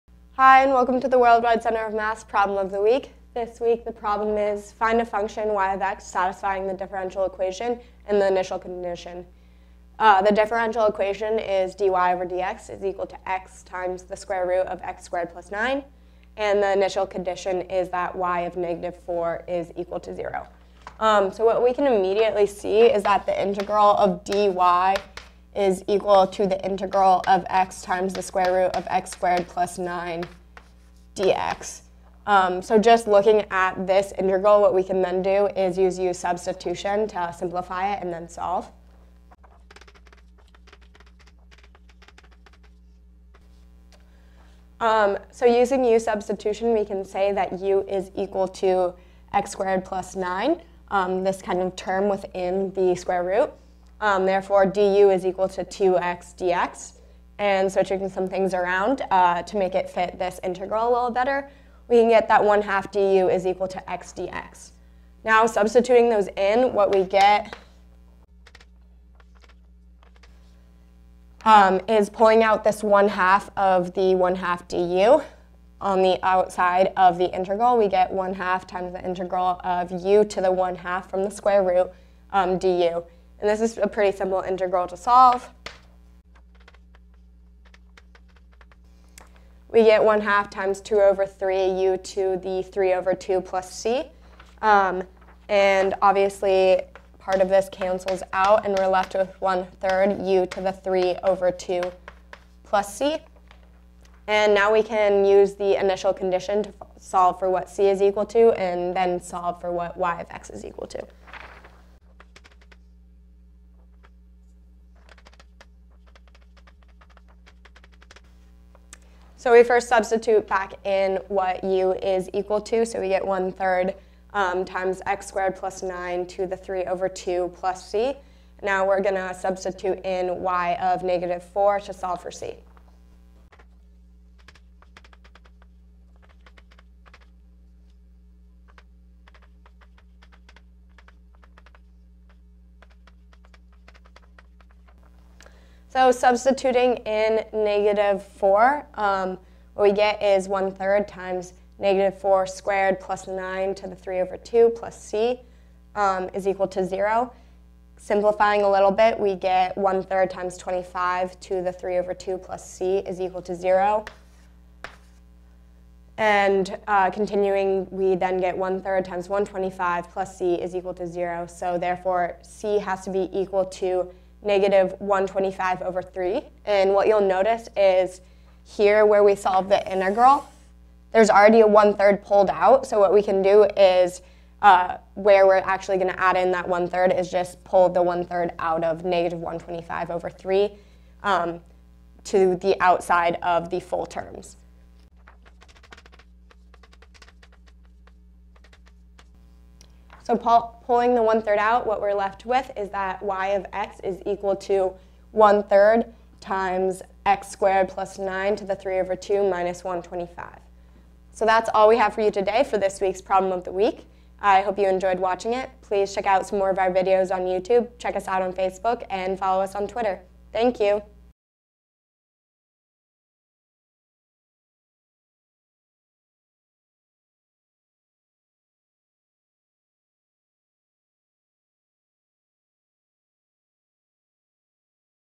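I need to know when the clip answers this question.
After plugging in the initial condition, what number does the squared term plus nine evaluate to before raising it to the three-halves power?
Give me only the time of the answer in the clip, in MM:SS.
02:40.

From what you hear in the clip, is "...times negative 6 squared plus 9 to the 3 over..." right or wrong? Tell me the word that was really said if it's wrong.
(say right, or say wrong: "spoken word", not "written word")
wrong: "4", not "6".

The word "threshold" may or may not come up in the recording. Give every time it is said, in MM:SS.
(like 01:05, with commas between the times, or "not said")
not said.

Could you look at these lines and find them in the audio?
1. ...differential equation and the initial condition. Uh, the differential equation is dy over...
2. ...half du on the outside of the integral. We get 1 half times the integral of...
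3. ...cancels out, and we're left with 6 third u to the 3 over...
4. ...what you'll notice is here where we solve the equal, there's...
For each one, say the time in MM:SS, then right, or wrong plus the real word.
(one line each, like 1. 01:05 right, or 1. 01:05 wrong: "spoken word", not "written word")
1. 00:06 right
2. 01:14 right
3. 01:37 wrong: "1", not "6"
4. 02:56 wrong: "integral", not "equal".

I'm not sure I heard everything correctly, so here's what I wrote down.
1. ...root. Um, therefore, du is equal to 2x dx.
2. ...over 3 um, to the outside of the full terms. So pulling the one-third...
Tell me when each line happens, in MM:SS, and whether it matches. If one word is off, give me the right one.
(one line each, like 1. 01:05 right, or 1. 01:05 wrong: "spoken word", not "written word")
1. 00:53 right
2. 03:10 right.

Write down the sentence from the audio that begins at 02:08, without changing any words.
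Now we're going to substitute in y of negative 4 to solve for c.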